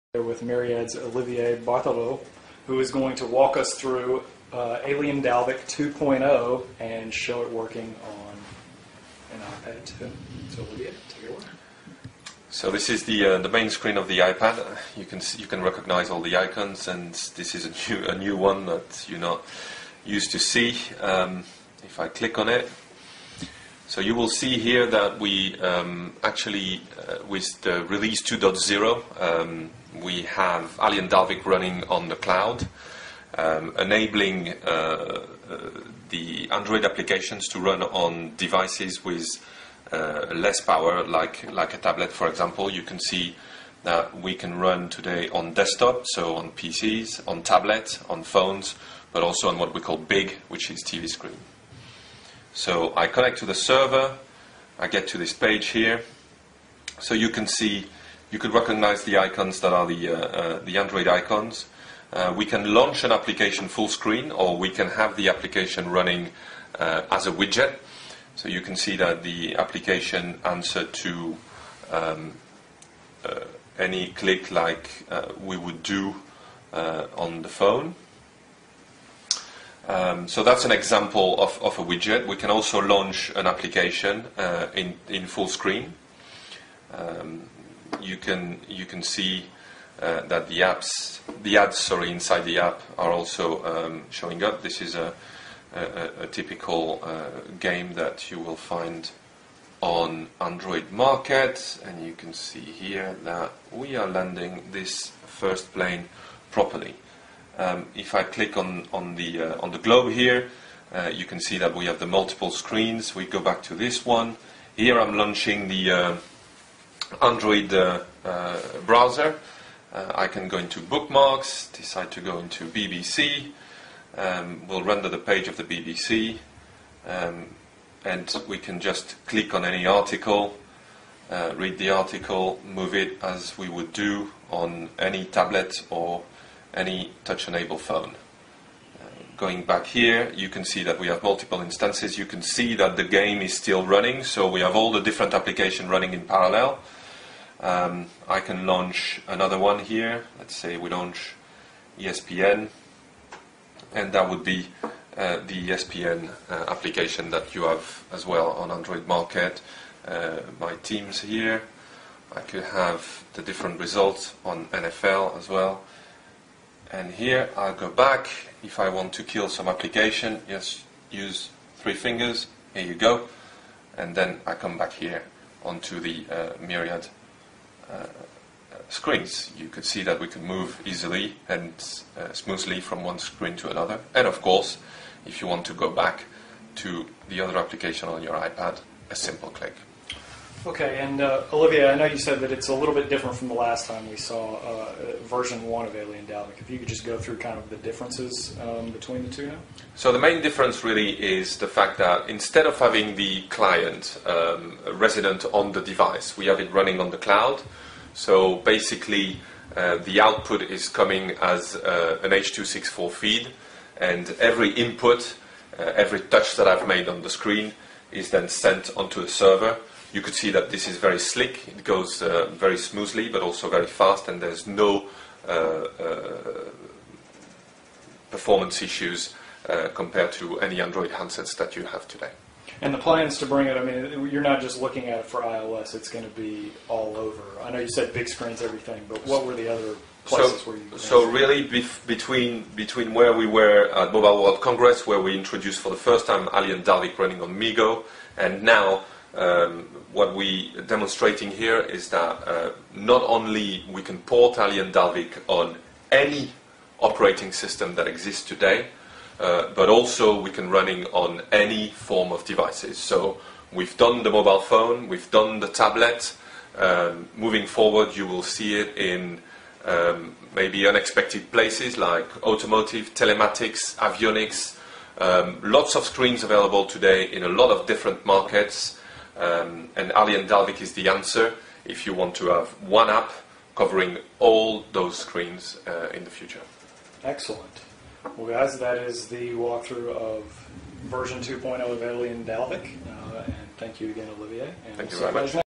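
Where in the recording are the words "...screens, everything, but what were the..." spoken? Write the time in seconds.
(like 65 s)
238 s.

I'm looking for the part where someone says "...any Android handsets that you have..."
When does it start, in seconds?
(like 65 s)
230 s.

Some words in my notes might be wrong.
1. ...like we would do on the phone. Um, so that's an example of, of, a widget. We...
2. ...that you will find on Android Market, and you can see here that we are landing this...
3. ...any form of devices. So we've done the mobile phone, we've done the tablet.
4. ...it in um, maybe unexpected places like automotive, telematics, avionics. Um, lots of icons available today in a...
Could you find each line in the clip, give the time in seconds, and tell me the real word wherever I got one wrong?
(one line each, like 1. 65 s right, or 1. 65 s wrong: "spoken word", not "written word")
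1. 74 s right
2. 97 s right
3. 261 s right
4. 268 s wrong: "screens", not "icons".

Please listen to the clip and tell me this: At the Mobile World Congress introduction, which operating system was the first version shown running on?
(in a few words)
MeeGo.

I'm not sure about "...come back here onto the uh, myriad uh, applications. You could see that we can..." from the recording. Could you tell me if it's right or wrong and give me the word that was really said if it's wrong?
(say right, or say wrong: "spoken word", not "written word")
wrong: "screens", not "applications".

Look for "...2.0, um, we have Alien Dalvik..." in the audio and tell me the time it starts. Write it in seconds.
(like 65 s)
28 s.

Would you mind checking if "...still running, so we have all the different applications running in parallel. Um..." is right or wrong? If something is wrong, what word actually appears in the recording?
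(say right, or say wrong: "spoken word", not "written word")
right.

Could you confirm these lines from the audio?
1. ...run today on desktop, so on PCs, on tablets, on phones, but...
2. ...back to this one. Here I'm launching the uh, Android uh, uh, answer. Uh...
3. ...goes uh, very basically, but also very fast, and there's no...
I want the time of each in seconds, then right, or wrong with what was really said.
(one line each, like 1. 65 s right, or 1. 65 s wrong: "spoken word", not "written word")
1. 44 s right
2. 113 s wrong: "browser", not "answer"
3. 221 s wrong: "smoothly", not "basically".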